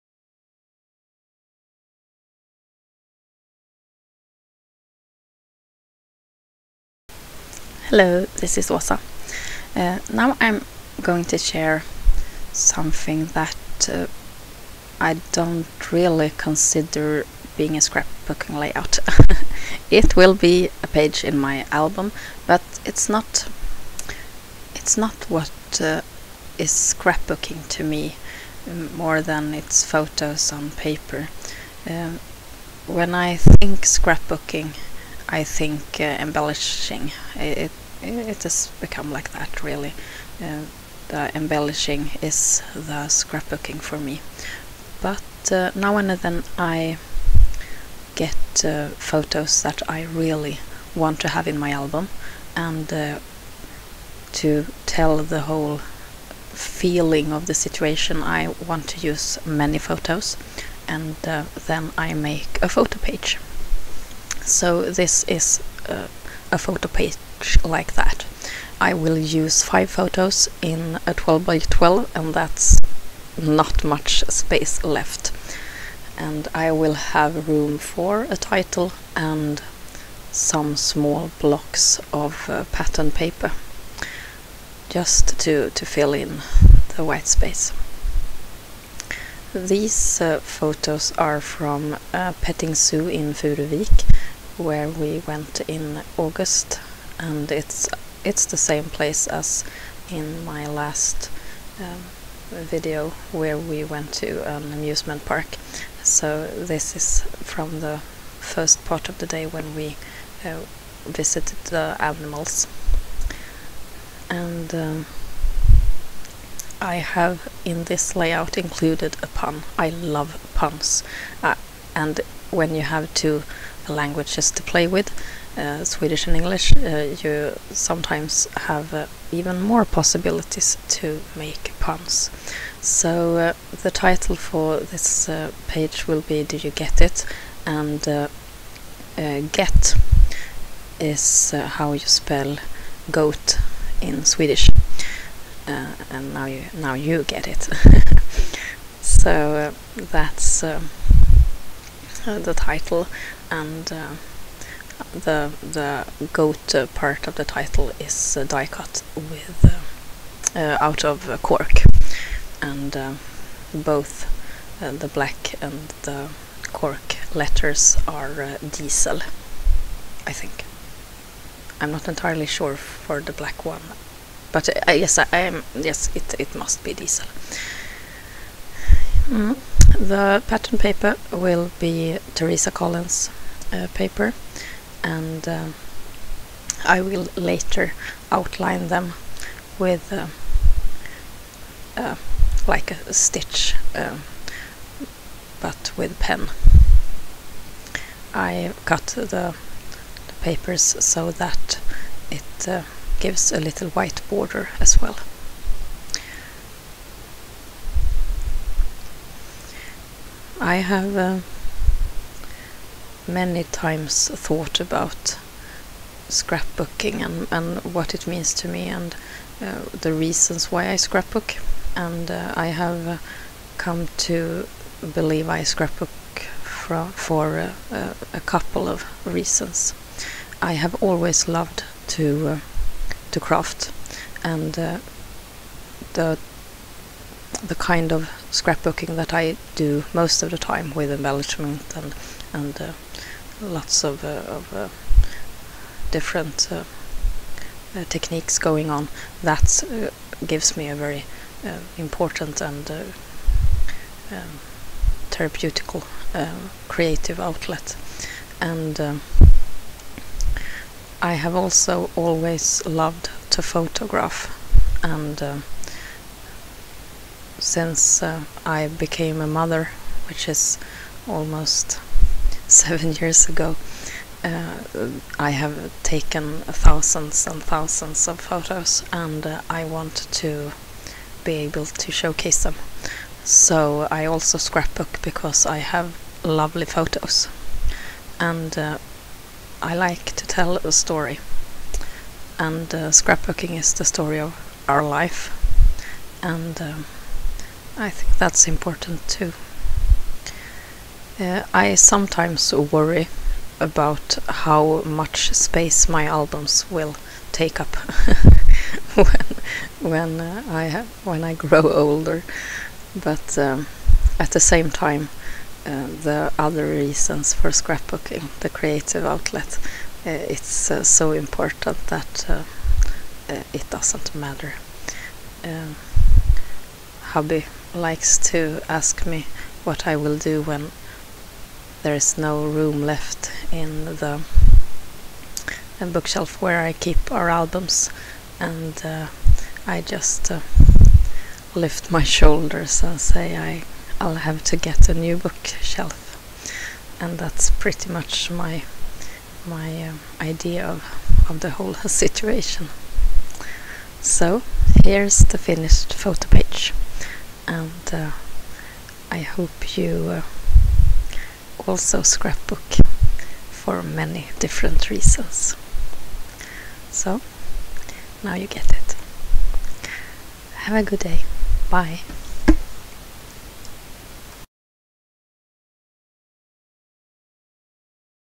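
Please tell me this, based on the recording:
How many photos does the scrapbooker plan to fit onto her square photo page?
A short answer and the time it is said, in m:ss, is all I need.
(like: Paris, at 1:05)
5, at 1:09.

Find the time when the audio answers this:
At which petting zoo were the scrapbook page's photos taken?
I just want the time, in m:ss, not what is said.
1:33.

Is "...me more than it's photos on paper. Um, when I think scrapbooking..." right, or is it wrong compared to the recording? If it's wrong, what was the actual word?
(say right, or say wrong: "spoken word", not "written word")
right.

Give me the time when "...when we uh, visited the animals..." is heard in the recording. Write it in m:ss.
1:49.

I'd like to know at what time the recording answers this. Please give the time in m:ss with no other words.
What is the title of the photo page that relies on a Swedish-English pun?
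2:16.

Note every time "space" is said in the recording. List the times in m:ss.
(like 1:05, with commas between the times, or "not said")
1:14, 1:27, 5:05.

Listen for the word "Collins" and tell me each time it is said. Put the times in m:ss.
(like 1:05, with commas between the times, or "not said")
3:02.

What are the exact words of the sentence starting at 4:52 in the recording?
And uh, scrapbooking is the story of our life and um, I think that's important too.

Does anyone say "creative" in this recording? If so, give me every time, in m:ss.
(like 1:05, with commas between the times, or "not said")
4:16, 5:18.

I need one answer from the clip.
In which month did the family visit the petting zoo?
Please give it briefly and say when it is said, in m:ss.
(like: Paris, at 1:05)
August, at 1:36.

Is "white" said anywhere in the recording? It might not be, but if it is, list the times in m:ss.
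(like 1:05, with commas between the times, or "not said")
1:27, 3:23.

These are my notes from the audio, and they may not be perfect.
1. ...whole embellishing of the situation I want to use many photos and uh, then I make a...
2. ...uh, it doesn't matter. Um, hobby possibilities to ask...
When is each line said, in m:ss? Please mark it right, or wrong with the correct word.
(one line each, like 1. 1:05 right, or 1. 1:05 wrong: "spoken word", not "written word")
1. 0:55 wrong: "feeling", not "embellishing"
2. 5:22 wrong: "likes", not "possibilities".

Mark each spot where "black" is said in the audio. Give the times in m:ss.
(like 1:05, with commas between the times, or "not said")
2:45, 2:53.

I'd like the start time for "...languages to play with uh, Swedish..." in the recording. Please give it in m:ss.
2:03.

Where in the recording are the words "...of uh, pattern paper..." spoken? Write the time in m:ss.
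1:22.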